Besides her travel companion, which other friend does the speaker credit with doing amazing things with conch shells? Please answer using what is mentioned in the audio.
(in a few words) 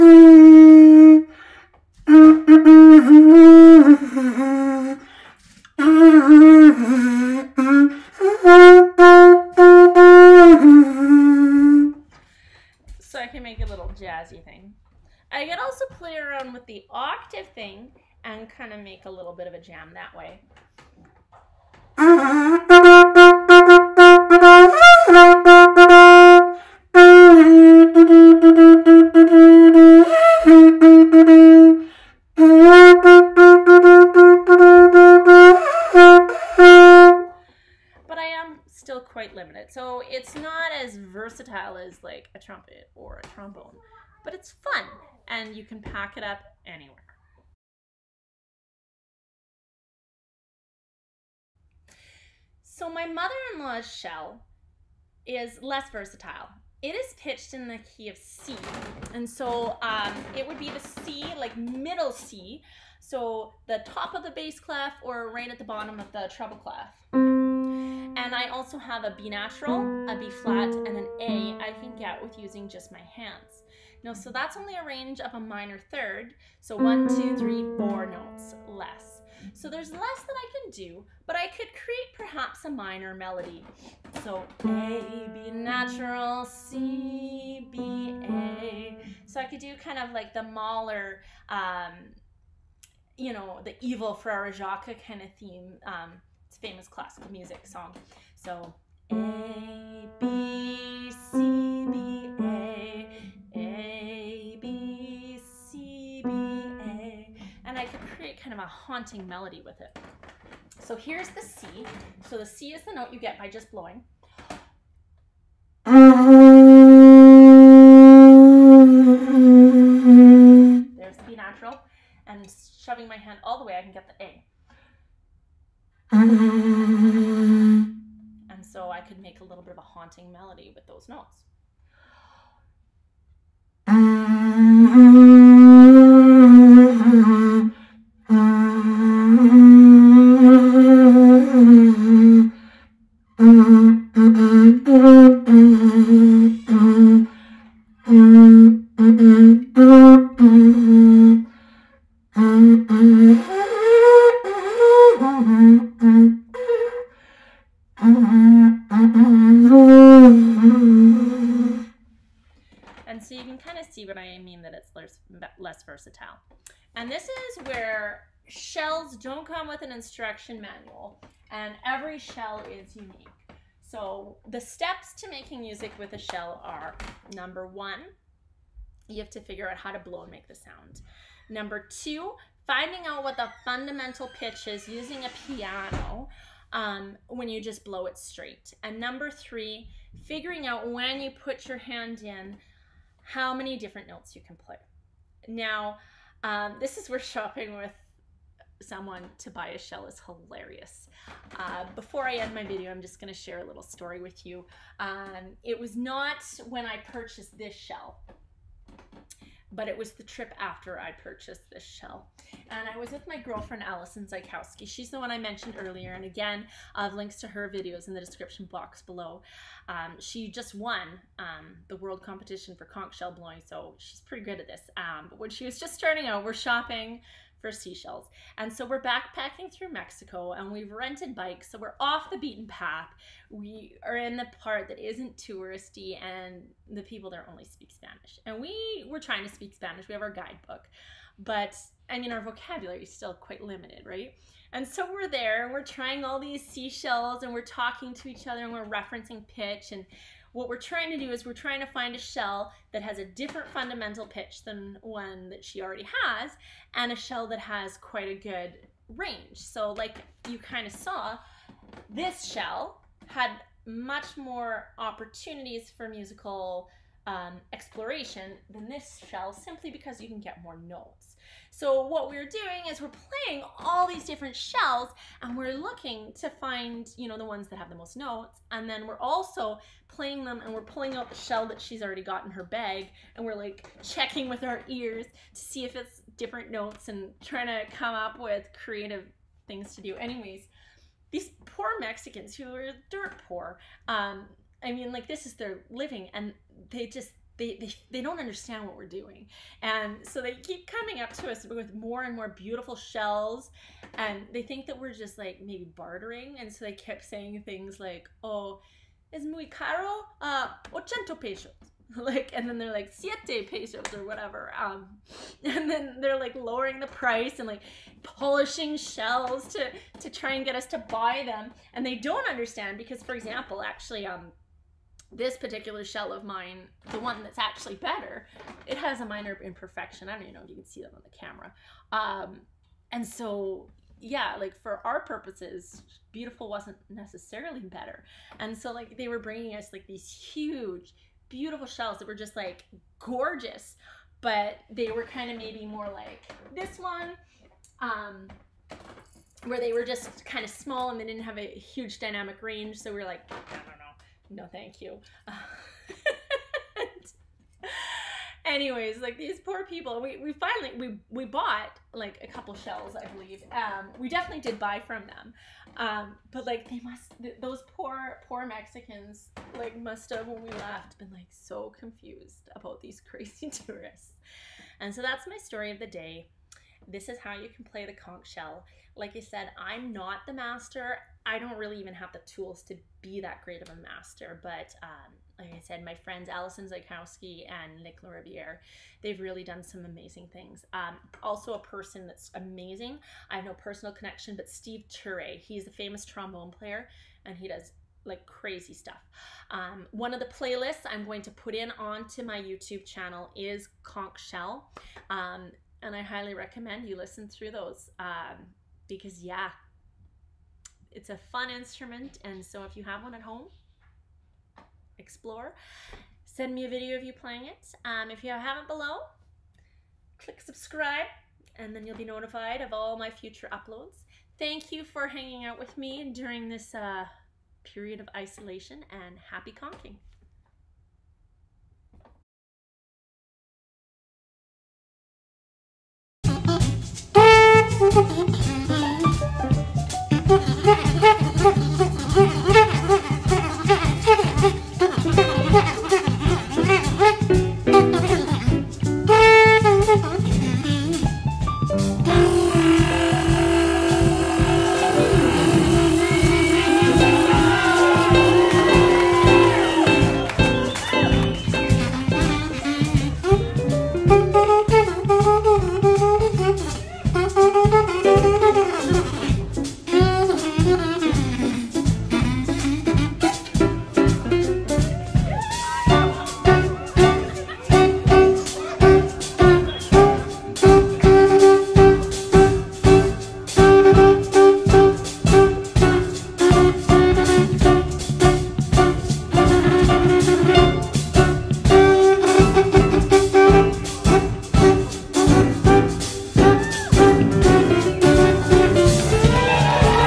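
Nick Lariviere.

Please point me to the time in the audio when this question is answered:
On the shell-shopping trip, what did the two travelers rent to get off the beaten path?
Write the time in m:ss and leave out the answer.
3:51.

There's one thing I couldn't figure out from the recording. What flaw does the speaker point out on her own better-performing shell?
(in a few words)
a minor imperfection.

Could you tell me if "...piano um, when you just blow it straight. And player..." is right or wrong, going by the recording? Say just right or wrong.
wrong.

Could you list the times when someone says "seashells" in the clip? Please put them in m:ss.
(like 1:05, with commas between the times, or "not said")
3:47, 4:06.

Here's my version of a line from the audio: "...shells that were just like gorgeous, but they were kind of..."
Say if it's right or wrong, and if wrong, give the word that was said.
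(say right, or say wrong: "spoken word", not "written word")
right.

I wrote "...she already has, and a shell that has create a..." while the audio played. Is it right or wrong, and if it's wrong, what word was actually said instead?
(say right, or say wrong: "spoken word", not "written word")
wrong: "quite", not "create".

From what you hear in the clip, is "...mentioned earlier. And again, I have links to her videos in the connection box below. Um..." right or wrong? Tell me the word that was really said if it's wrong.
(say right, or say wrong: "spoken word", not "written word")
wrong: "description", not "connection".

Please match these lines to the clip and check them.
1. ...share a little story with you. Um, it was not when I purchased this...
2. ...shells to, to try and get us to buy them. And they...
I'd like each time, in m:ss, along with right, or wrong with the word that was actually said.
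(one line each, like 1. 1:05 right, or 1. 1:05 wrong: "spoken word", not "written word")
1. 3:23 right
2. 5:18 right.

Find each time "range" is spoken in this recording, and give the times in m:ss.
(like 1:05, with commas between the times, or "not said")
1:14, 4:19, 5:52.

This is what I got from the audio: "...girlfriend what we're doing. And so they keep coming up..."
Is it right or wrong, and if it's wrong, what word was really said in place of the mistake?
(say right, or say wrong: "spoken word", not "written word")
wrong: "understand", not "girlfriend".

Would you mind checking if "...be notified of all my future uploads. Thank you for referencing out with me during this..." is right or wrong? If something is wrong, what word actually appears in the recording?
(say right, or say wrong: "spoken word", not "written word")
wrong: "hanging", not "referencing".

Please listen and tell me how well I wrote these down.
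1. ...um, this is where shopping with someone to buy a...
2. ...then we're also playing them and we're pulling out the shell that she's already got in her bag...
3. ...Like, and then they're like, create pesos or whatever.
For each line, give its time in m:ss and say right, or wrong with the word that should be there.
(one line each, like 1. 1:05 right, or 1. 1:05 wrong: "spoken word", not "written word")
1. 3:16 right
2. 4:38 right
3. 5:12 wrong: "siete", not "create".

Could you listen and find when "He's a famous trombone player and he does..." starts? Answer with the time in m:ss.
6:35.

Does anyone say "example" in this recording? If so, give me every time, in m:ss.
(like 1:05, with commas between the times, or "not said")
5:23.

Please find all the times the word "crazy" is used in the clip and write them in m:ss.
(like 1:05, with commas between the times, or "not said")
6:13, 6:38.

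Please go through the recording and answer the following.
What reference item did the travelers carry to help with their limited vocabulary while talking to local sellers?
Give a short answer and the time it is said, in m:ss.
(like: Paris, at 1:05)
guidebook, at 4:00.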